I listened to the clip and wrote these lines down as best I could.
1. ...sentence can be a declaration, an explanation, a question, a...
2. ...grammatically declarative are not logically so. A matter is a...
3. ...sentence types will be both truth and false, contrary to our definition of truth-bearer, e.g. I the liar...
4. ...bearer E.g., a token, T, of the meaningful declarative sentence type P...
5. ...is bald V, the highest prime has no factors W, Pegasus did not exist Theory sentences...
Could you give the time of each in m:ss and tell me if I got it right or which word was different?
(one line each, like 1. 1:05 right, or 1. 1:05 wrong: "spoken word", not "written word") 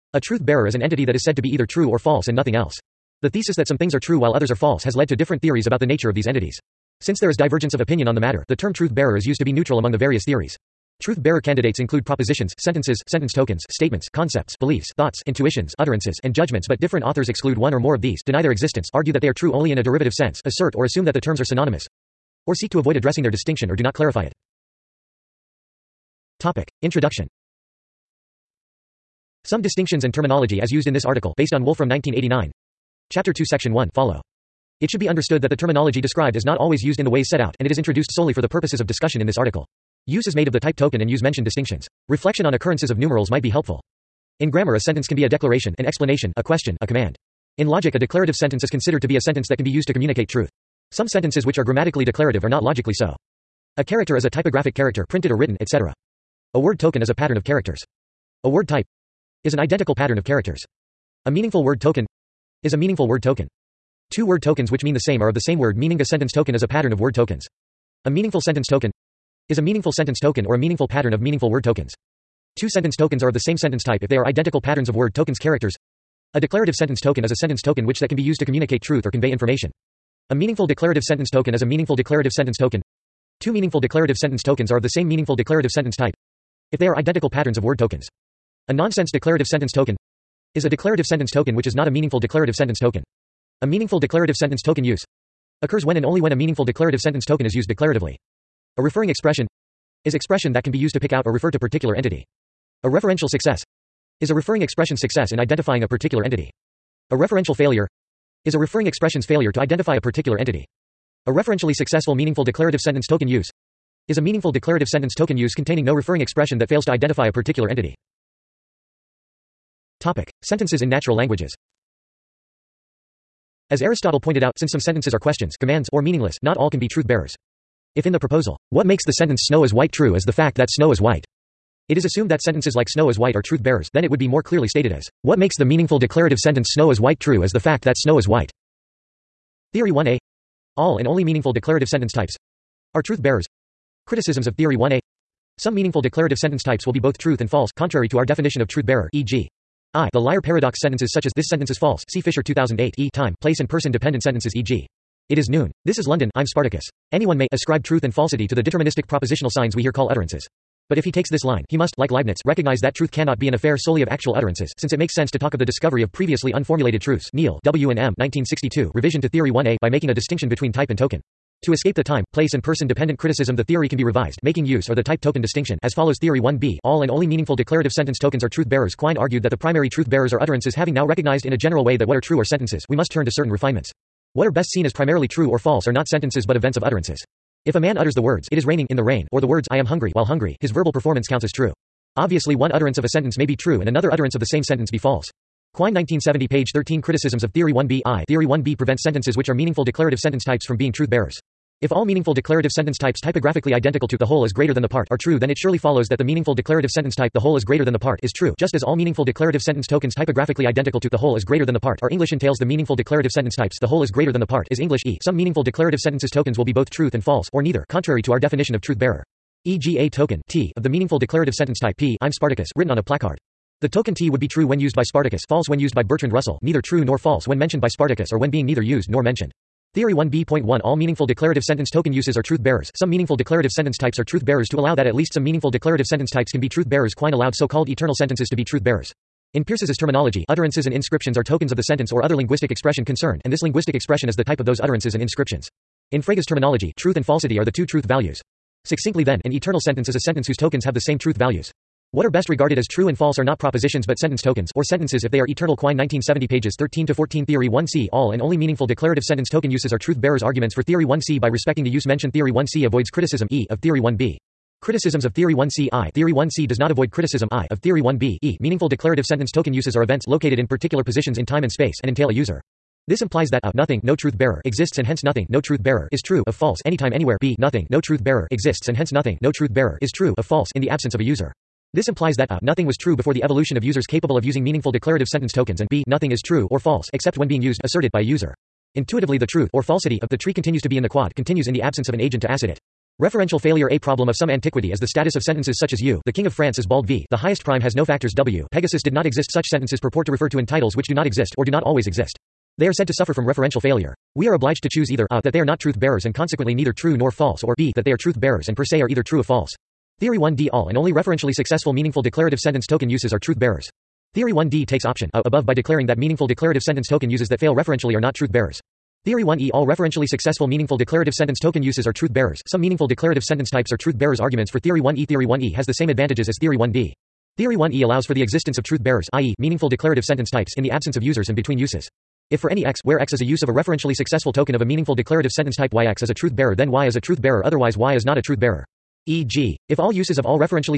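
1. 0:44 right
2. 0:51 wrong: "character", not "matter"
3. 2:26 right
4. 3:38 right
5. 4:56 wrong: "Such", not "Theory".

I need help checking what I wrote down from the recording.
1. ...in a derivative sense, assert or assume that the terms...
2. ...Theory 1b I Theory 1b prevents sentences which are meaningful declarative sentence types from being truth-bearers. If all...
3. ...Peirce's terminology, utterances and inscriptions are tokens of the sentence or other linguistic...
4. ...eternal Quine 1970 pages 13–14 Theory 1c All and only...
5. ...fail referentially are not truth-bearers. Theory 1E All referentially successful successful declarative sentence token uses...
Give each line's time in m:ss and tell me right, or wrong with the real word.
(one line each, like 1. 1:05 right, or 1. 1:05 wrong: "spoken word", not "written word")
1. 0:19 right
2. 3:17 right
3. 3:59 right
4. 4:15 right
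5. 5:17 wrong: "meaningful", not "successful".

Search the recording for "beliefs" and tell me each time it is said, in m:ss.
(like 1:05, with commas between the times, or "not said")
0:14.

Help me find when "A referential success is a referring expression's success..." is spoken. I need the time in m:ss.
1:42.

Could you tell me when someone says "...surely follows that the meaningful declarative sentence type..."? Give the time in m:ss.
3:25.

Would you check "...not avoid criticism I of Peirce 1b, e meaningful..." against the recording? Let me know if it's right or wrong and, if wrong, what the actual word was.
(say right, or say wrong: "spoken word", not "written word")
wrong: "Theory", not "Peirce".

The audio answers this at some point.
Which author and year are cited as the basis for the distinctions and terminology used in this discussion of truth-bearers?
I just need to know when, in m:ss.
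0:31.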